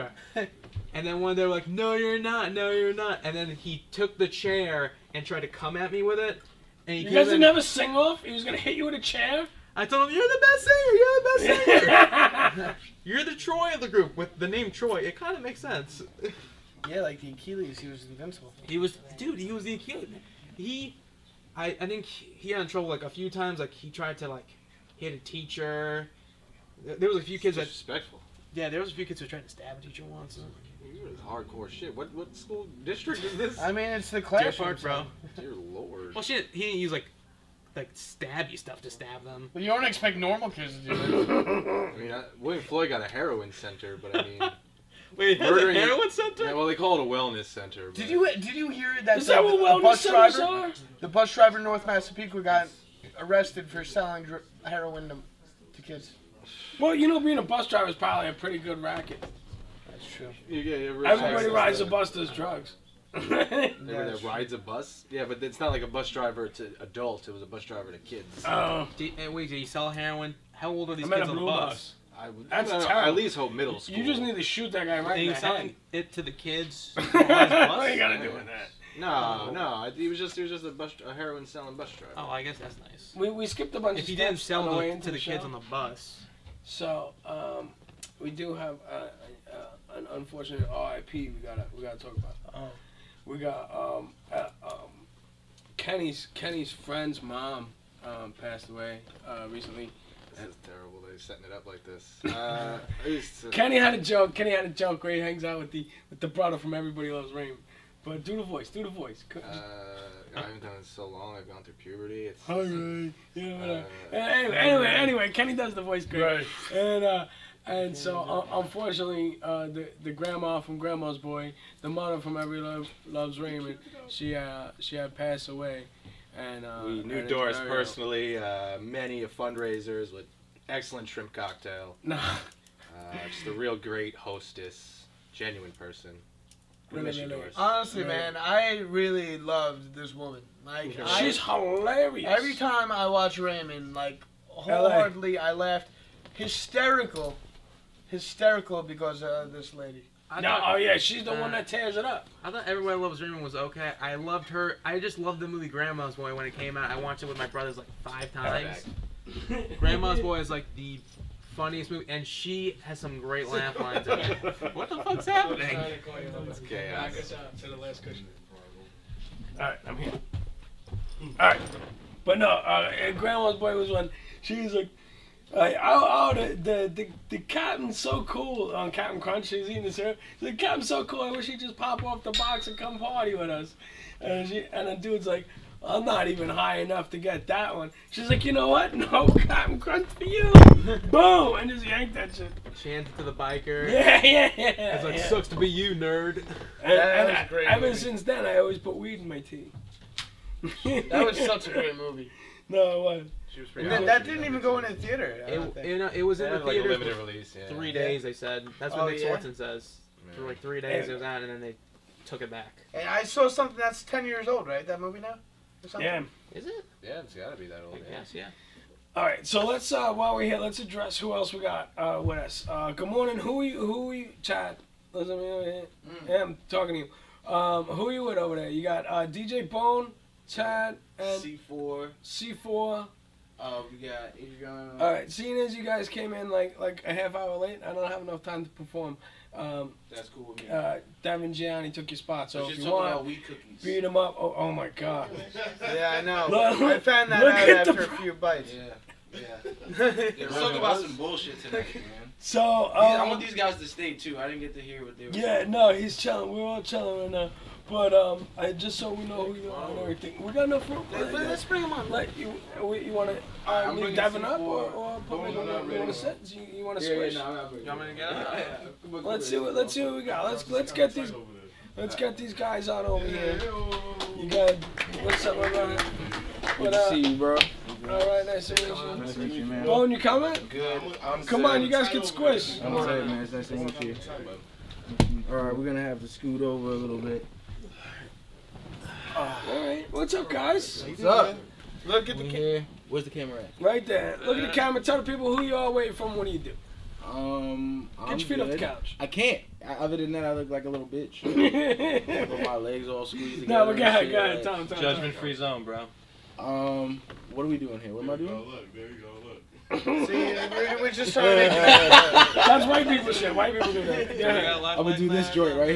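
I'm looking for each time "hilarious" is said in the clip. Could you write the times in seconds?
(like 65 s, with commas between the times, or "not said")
141 s.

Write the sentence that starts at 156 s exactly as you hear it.
I watched it with my brothers like five times.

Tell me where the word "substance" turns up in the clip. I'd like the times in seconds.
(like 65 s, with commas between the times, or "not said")
not said.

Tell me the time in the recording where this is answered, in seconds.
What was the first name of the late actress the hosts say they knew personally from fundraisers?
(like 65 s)
127 s.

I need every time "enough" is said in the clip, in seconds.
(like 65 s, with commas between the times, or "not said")
186 s, 238 s, 260 s.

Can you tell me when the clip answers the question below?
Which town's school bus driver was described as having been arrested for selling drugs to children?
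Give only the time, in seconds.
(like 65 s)
51 s.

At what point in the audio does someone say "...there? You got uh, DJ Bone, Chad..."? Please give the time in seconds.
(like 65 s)
228 s.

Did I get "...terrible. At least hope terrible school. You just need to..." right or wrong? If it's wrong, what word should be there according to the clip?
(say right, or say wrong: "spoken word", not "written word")
wrong: "middle", not "terrible".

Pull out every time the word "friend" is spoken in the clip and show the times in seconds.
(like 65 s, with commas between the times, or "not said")
96 s.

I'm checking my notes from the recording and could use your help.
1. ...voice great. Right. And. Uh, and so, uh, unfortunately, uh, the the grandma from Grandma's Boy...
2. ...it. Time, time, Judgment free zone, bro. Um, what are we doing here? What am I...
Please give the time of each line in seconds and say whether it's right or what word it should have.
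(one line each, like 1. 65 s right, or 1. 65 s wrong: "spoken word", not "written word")
1. 115 s right
2. 304 s right.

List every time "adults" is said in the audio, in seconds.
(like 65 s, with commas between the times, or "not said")
66 s.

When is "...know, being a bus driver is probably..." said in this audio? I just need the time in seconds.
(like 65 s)
57 s.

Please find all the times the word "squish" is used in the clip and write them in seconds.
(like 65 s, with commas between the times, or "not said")
267 s, 282 s.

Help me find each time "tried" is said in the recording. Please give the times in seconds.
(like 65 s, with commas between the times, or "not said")
5 s, 23 s.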